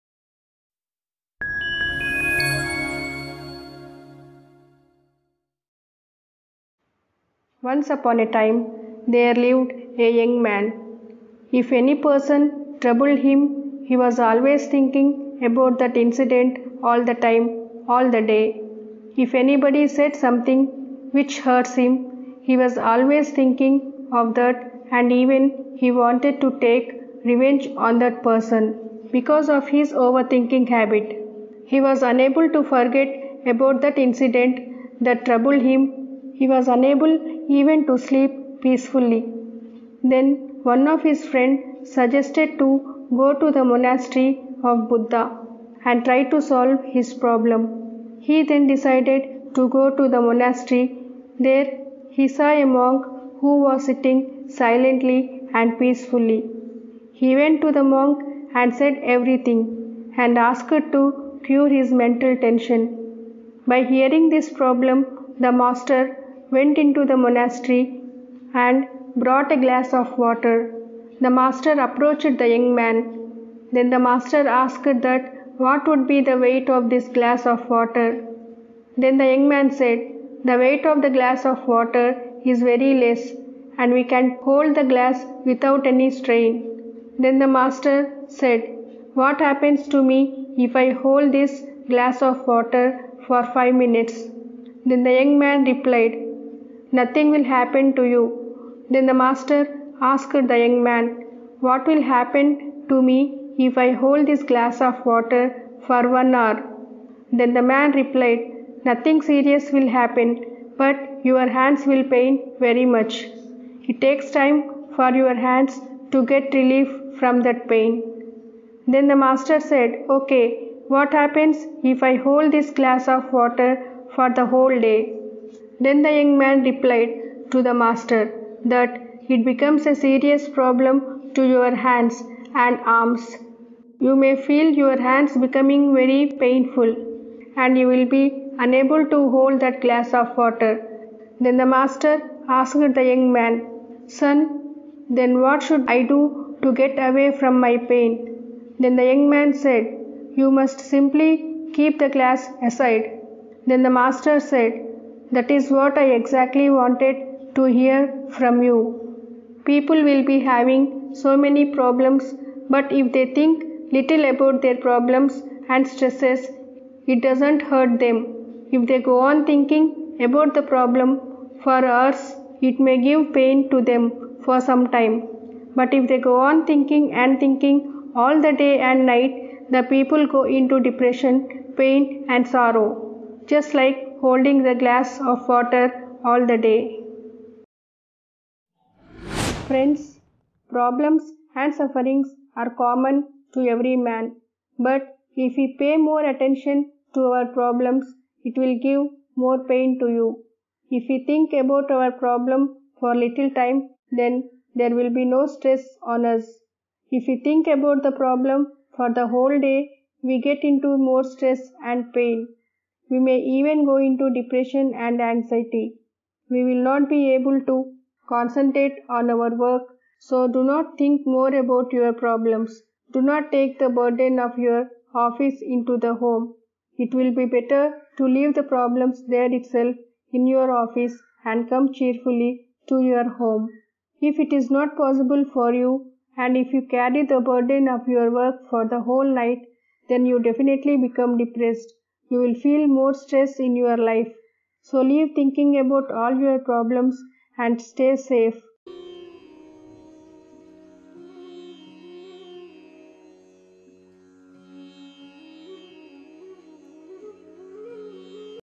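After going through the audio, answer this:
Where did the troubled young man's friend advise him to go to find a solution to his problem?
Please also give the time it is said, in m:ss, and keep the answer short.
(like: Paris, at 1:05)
monastery of Buddha, at 0:43.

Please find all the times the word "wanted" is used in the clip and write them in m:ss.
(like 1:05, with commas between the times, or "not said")
0:25, 2:36.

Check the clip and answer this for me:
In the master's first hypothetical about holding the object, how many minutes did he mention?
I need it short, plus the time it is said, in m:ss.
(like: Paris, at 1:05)
5, at 1:33.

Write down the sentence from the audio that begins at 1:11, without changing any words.
The master approached the young man.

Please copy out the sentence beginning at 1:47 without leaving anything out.
Then the man replied, Nothing serious will happen, but your hands will pain very much.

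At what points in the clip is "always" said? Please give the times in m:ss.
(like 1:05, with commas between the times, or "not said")
0:14, 0:22.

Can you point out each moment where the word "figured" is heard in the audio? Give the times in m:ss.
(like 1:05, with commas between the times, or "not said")
not said.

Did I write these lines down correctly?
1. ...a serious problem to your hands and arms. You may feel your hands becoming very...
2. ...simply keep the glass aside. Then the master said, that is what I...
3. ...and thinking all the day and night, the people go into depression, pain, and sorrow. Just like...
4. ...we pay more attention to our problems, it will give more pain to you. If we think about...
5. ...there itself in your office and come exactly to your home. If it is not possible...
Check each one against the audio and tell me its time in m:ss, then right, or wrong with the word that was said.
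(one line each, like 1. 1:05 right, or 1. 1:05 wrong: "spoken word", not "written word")
1. 2:09 right
2. 2:30 right
3. 2:57 right
4. 3:15 right
5. 3:49 wrong: "cheerfully", not "exactly".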